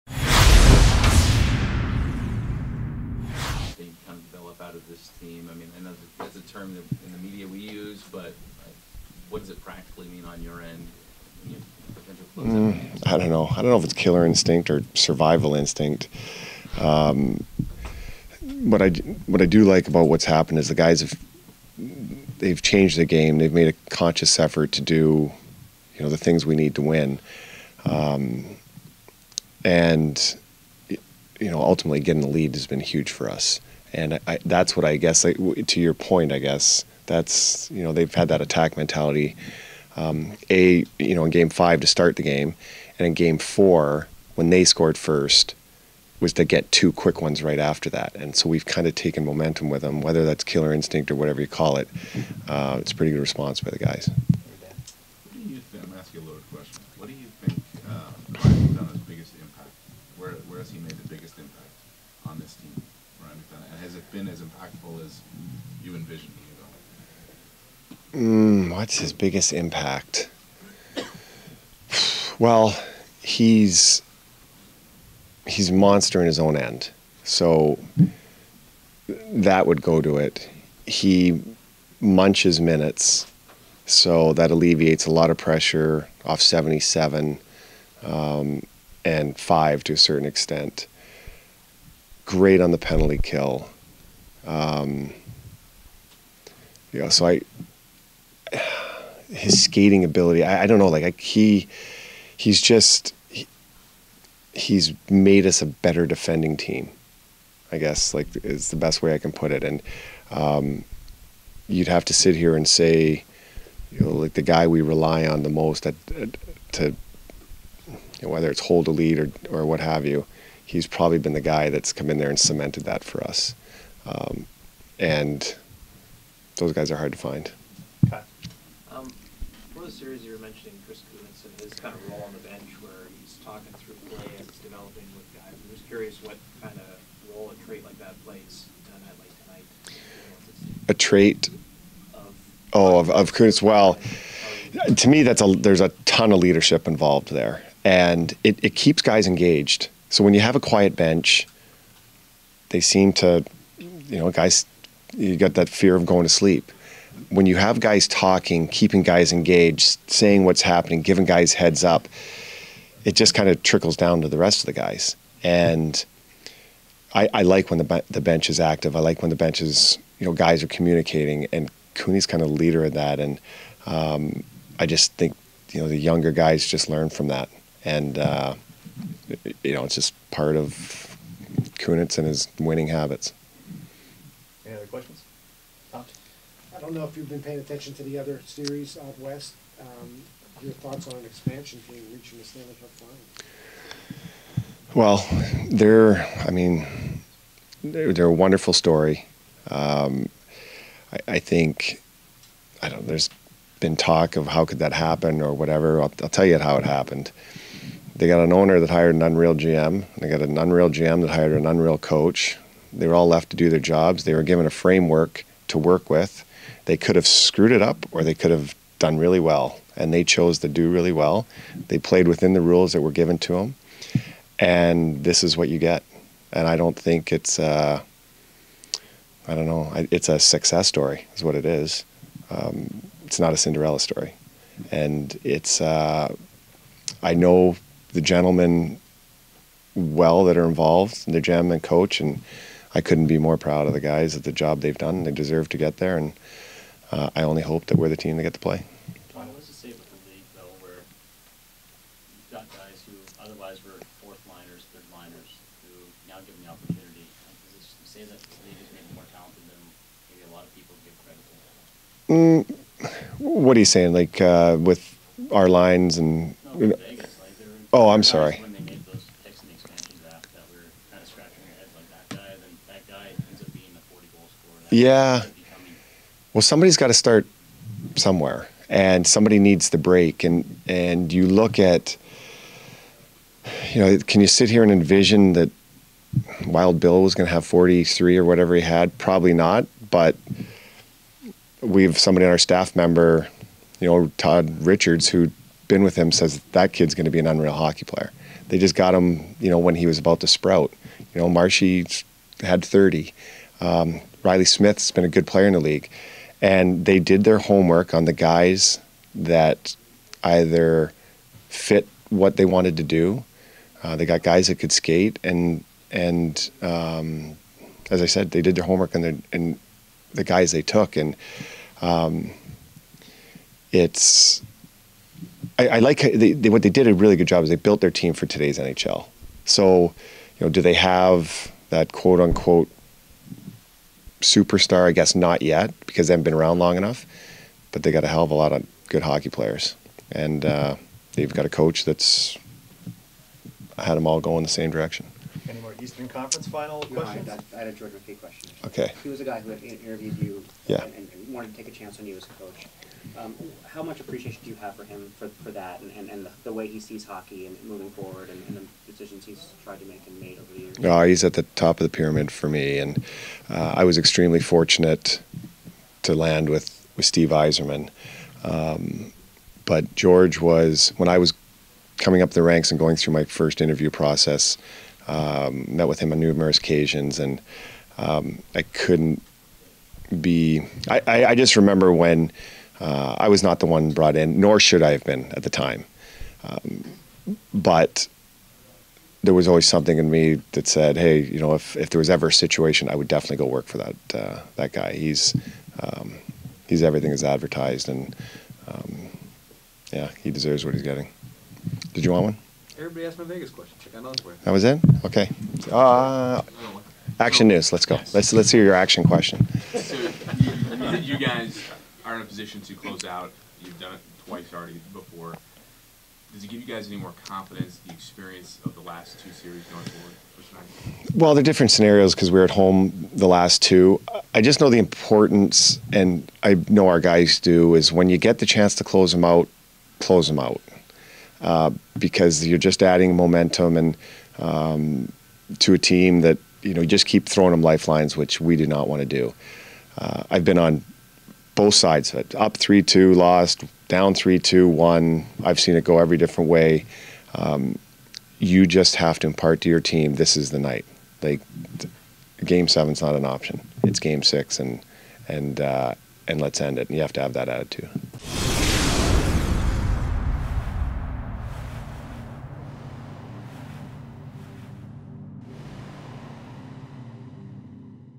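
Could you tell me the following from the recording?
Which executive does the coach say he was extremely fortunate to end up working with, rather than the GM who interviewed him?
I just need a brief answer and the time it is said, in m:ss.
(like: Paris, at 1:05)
Steve Yzerman, at 6:07.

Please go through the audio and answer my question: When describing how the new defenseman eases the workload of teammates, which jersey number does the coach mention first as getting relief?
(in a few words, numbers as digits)
77.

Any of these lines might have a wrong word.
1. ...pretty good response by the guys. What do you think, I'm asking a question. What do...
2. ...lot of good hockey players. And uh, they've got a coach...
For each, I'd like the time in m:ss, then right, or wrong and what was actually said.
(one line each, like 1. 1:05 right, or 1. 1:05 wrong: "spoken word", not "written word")
1. 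0:52 right
2. 5:38 right.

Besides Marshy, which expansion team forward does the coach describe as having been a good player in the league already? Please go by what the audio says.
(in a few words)
Reilly Smith.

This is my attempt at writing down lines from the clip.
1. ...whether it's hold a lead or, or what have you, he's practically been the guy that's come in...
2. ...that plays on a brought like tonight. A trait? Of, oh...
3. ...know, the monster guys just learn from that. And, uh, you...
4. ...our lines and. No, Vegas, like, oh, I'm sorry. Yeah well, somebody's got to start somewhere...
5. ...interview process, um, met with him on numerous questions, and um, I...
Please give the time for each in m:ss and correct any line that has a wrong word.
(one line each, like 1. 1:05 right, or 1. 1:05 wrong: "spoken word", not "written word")
1. 1:58 wrong: "probably", not "practically"
2. 2:17 wrong: "night", not "brought"
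3. 2:55 wrong: "younger", not "monster"
4. 4:25 right
5. 6:13 wrong: "occasions", not "questions".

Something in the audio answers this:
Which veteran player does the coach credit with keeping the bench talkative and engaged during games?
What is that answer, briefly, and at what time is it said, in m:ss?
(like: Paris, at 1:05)
Chris Kunitz, at 2:10.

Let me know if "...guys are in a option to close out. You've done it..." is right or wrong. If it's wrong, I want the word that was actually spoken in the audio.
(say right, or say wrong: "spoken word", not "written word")
wrong: "position", not "option".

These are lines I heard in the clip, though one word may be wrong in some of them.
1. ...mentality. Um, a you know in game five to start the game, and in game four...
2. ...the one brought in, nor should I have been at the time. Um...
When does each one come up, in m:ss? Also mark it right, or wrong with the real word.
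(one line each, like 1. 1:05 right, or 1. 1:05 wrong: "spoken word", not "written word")
1. 0:38 right
2. 6:23 right.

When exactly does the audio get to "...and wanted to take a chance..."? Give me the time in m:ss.
5:51.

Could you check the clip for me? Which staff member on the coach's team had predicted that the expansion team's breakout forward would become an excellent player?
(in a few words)
Todd Richards.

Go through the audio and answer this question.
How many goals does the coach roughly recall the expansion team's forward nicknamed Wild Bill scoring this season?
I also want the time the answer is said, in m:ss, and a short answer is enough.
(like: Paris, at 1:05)
43, at 4:47.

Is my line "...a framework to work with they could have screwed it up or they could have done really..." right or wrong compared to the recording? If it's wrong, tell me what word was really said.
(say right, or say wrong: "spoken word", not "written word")
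right.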